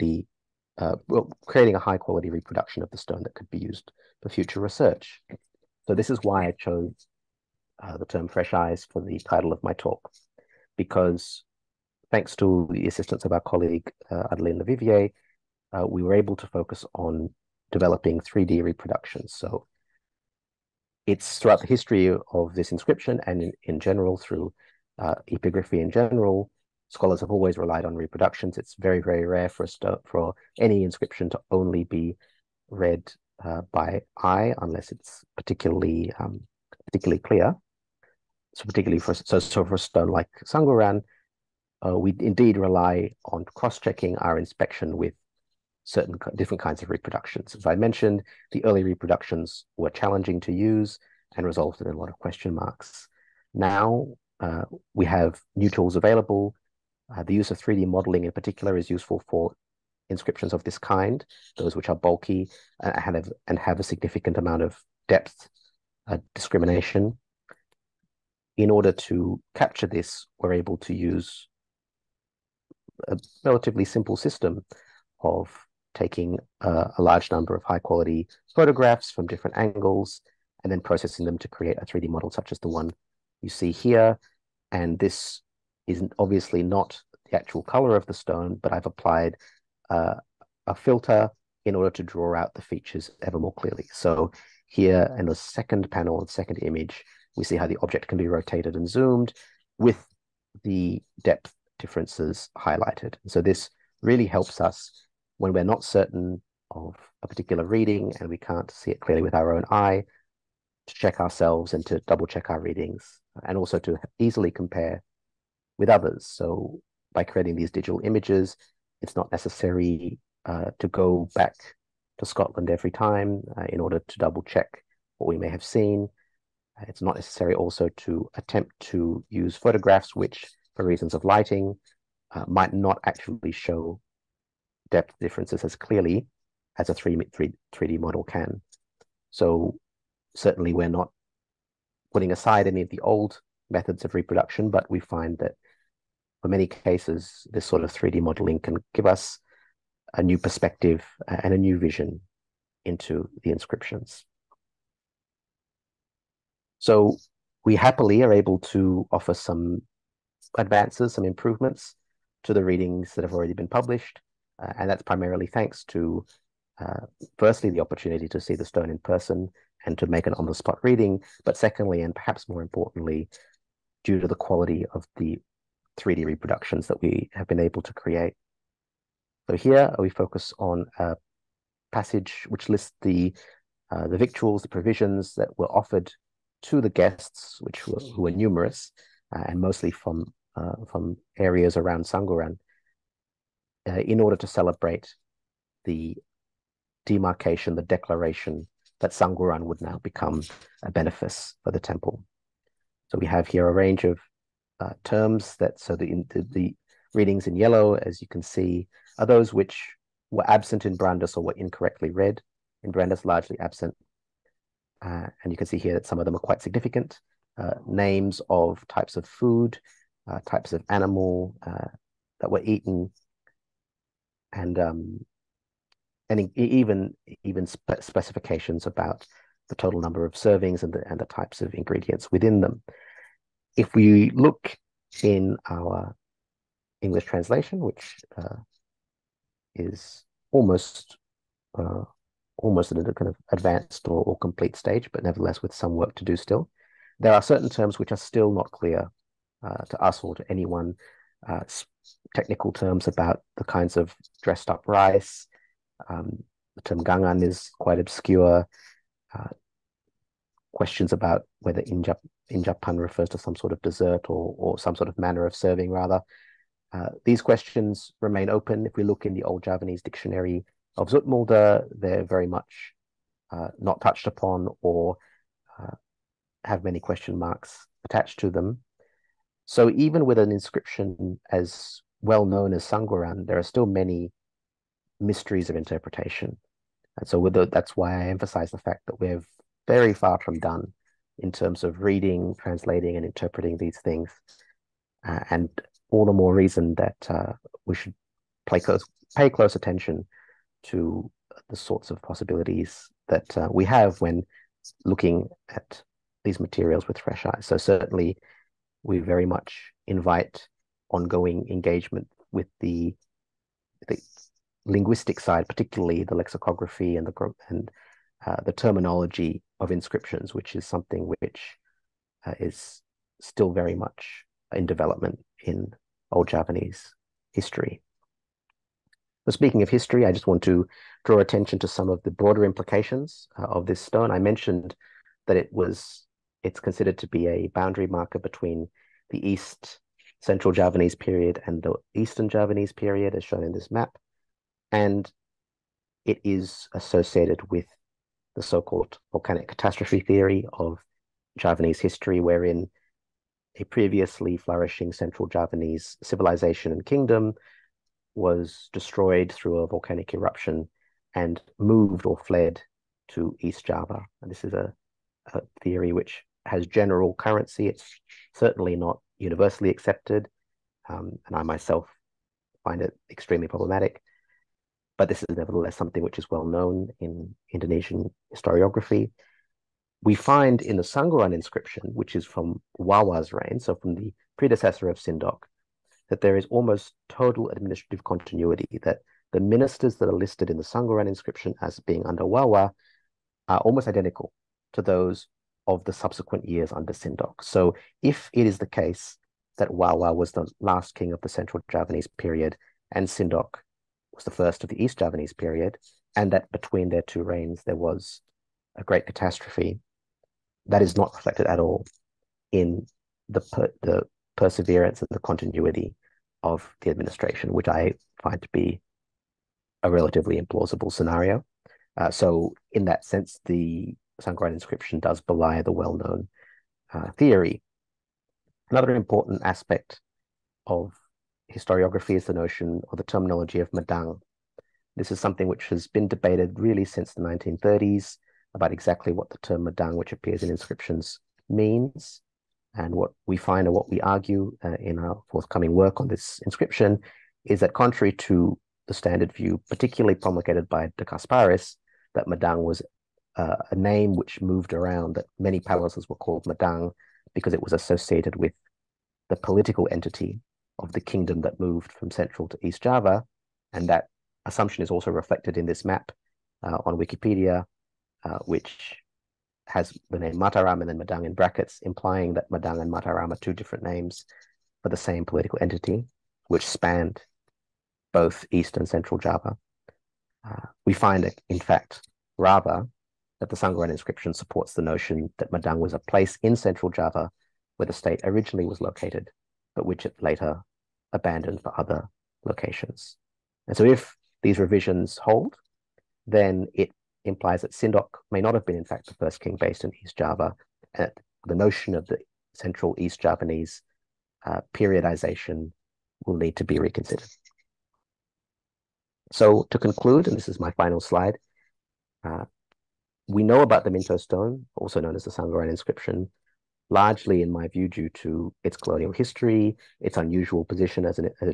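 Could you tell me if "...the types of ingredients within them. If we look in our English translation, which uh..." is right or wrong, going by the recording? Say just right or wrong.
right.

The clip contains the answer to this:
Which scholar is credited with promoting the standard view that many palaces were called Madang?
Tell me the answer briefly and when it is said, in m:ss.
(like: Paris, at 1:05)
de Casparis, at 7:31.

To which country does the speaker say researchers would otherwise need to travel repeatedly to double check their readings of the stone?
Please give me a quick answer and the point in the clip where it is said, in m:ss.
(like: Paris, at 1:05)
Scotland, at 2:02.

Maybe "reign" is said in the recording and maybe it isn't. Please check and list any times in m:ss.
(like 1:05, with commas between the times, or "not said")
6:23, 6:47.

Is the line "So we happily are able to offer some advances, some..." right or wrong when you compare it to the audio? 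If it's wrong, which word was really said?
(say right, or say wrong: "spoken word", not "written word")
right.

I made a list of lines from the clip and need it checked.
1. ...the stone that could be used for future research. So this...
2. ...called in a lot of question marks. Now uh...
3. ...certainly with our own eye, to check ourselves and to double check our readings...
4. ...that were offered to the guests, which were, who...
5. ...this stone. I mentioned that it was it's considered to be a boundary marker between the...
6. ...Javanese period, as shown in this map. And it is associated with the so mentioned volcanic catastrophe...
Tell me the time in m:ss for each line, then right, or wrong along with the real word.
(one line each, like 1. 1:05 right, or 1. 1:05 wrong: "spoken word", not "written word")
1. 0:02 right
2. 0:51 wrong: "resulted", not "called"
3. 1:48 wrong: "clearly", not "certainly"
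4. 3:05 right
5. 5:33 right
6. 5:42 wrong: "called", not "mentioned".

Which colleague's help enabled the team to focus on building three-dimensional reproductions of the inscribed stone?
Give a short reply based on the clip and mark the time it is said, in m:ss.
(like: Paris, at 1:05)
Adeline Levivier, at 0:14.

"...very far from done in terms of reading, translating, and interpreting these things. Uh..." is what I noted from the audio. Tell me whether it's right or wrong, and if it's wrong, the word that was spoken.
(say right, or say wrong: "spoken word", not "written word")
right.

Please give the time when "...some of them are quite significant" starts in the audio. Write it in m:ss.
3:36.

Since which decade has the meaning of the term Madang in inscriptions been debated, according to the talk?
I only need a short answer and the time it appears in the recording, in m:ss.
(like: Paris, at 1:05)
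1930s, at 7:17.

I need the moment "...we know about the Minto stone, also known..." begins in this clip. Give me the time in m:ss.
8:33.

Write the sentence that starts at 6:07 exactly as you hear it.
It's certainly not universally accepted, um, and I myself find it extremely problematic.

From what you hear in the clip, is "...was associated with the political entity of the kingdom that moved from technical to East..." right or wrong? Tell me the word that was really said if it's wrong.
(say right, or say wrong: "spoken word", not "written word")
wrong: "central", not "technical".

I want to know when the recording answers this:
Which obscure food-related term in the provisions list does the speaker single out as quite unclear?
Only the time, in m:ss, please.
4:17.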